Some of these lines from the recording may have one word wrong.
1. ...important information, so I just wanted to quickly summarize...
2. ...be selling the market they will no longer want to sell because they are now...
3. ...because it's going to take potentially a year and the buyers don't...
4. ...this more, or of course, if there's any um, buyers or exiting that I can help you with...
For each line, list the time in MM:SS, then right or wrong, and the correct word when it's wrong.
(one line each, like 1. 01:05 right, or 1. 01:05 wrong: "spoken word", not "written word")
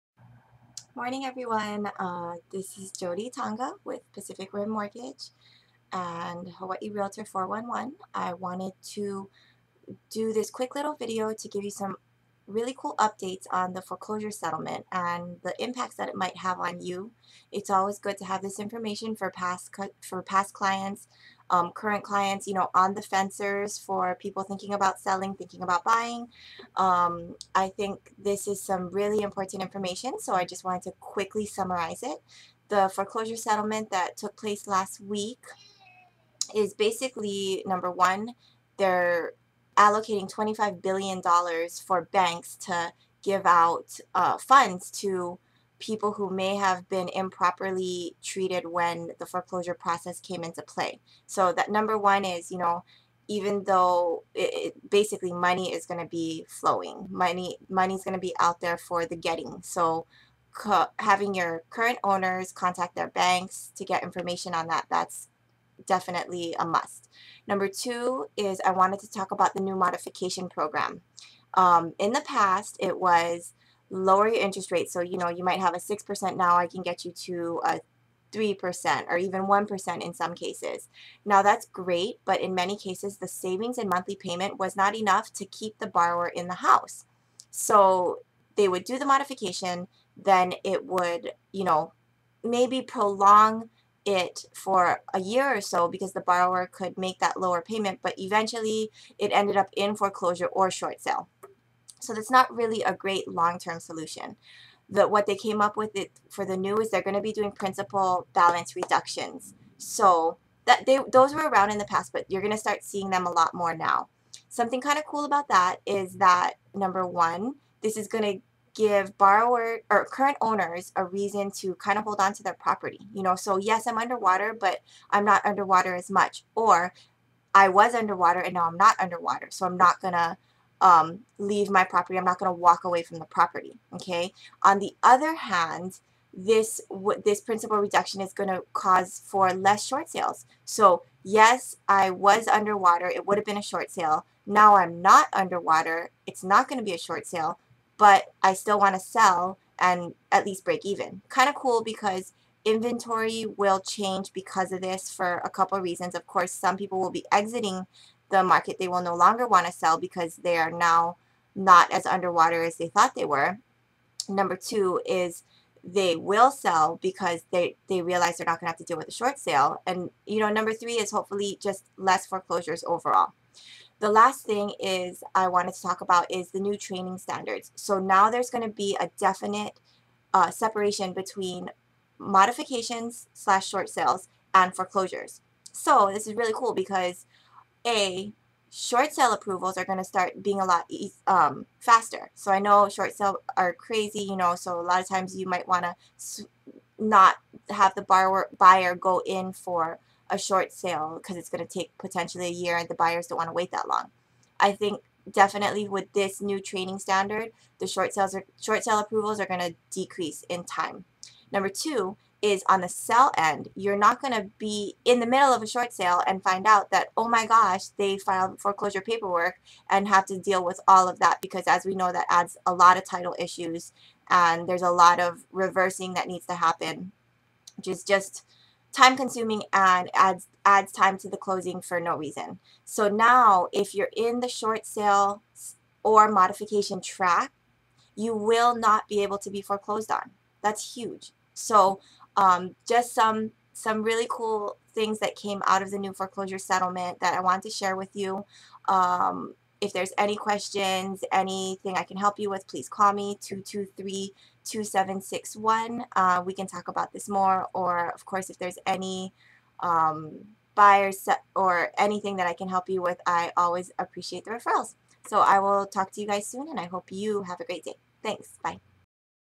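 1. 00:29 right
2. 02:37 wrong: "exiting", not "selling"
3. 03:21 right
4. 04:17 wrong: "anything", not "exiting".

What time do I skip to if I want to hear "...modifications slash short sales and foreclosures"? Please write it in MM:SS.
03:02.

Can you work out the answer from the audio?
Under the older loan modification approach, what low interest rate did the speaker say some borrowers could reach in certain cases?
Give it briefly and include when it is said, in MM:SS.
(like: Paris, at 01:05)
1%, at 01:19.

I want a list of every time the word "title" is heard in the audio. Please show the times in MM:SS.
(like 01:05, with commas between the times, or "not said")
03:43.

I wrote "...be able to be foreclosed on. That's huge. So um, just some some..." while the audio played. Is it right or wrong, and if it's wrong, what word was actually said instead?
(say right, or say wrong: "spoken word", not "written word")
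right.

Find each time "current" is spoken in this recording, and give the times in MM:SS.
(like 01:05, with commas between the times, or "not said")
00:21, 01:01, 02:00.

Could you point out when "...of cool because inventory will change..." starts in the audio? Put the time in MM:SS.
02:31.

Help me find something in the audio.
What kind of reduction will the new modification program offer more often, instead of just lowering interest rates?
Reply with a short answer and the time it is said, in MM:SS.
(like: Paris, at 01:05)
Principal balance reductions, at 01:47.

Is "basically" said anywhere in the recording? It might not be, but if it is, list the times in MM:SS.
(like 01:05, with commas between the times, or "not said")
00:36, 00:54.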